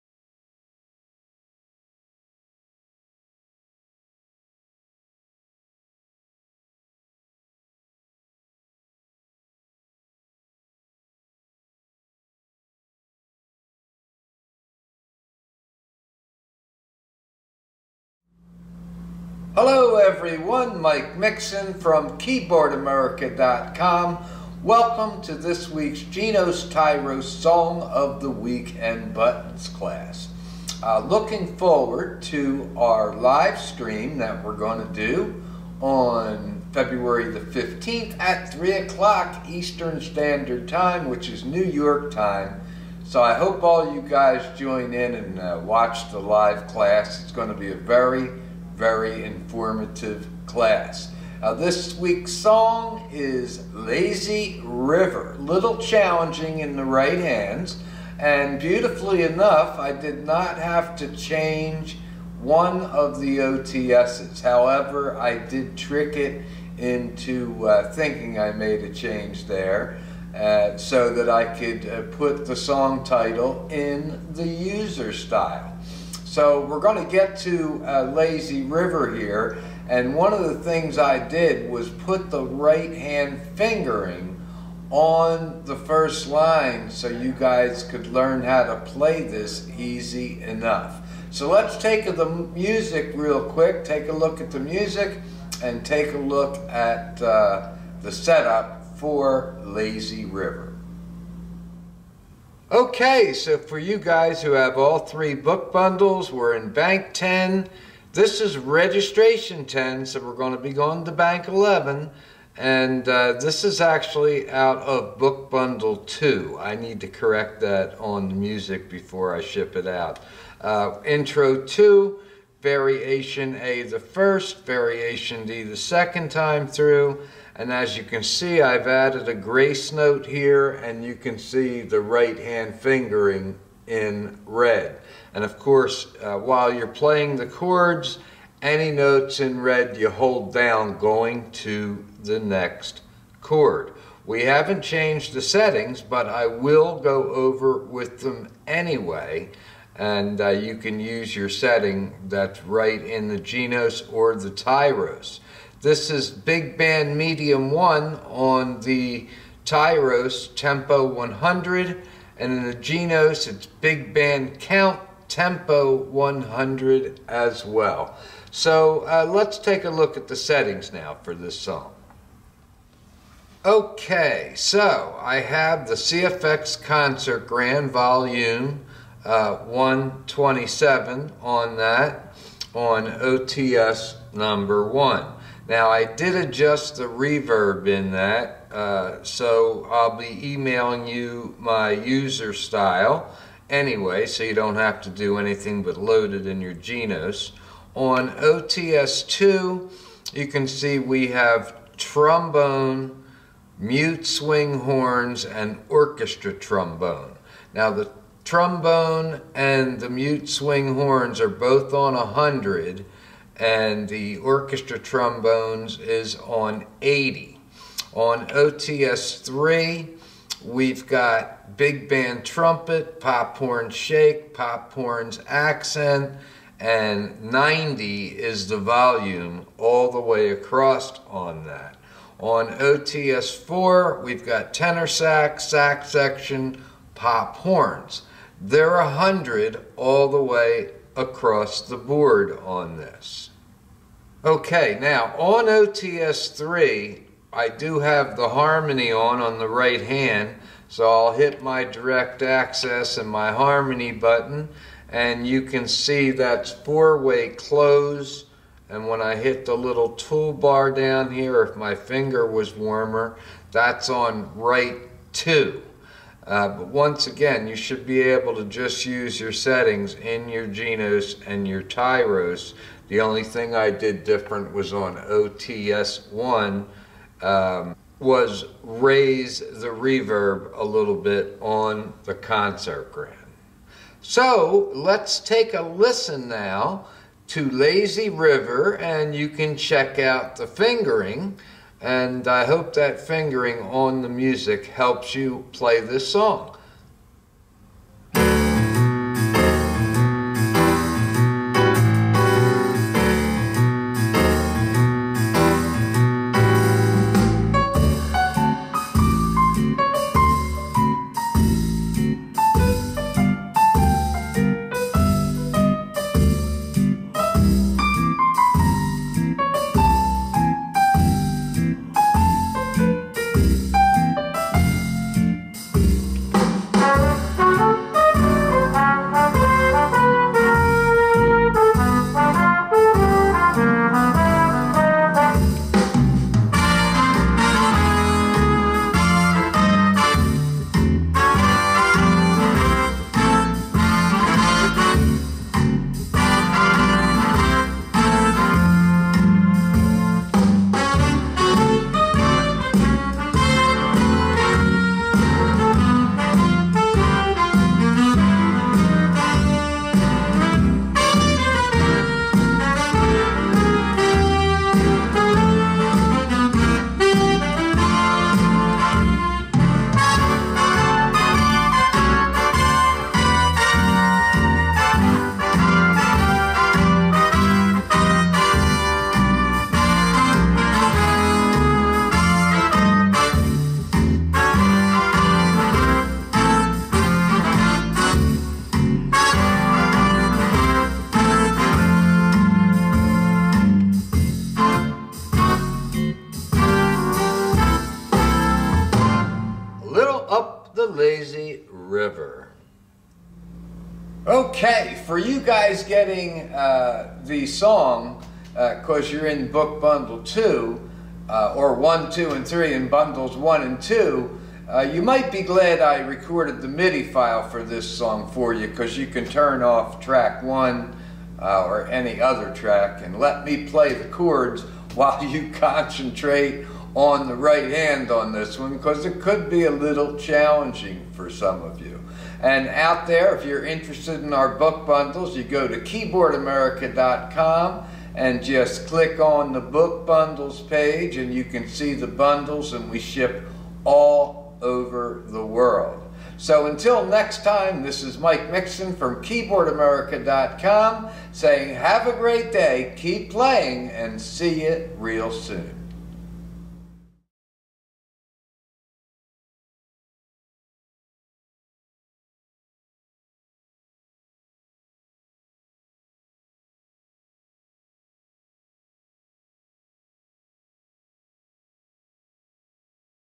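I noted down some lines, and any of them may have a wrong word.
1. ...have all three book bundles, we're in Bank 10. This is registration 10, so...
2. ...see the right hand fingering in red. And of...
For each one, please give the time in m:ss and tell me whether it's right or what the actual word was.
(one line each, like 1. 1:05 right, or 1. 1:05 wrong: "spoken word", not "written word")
1. 1:44 right
2. 2:11 right.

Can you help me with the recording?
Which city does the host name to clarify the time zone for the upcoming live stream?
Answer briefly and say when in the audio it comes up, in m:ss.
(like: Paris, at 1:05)
New York, at 0:41.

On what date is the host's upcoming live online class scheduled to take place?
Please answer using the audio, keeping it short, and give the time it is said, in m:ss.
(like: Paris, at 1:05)
February 15, at 0:36.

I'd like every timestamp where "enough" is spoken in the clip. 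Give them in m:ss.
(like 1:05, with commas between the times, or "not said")
0:59, 1:30.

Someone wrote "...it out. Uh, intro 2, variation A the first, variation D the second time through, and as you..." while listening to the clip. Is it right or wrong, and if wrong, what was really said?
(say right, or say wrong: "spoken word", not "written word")
right.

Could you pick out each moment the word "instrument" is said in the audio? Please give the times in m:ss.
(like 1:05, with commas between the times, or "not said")
not said.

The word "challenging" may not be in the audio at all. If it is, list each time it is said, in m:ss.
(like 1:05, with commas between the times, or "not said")
0:55, 7:10.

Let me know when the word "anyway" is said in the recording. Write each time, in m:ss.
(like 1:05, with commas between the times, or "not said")
2:28, 3:13.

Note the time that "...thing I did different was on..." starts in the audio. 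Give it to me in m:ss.
4:33.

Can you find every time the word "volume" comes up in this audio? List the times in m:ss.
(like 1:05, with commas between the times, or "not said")
2:57, 3:48.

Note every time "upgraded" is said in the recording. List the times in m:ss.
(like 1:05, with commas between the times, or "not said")
not said.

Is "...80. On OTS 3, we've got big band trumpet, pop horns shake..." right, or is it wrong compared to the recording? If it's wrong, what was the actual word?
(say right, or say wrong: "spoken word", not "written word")
right.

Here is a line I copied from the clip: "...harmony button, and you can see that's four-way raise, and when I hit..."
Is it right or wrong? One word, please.
wrong.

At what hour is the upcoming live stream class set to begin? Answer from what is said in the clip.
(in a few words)
3 o'clock.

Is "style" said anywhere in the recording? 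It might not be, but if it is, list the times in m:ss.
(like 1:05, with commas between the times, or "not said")
1:15, 3:12.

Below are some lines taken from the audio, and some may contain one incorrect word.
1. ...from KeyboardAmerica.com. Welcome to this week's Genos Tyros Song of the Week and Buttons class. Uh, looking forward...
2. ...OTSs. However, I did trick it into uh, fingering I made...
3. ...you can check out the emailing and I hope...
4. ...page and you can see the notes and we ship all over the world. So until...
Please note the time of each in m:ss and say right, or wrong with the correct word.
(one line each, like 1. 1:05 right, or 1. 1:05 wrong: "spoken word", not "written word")
1. 0:21 right
2. 1:03 wrong: "thinking", not "fingering"
3. 4:49 wrong: "fingering", not "emailing"
4. 7:20 wrong: "bundles", not "notes".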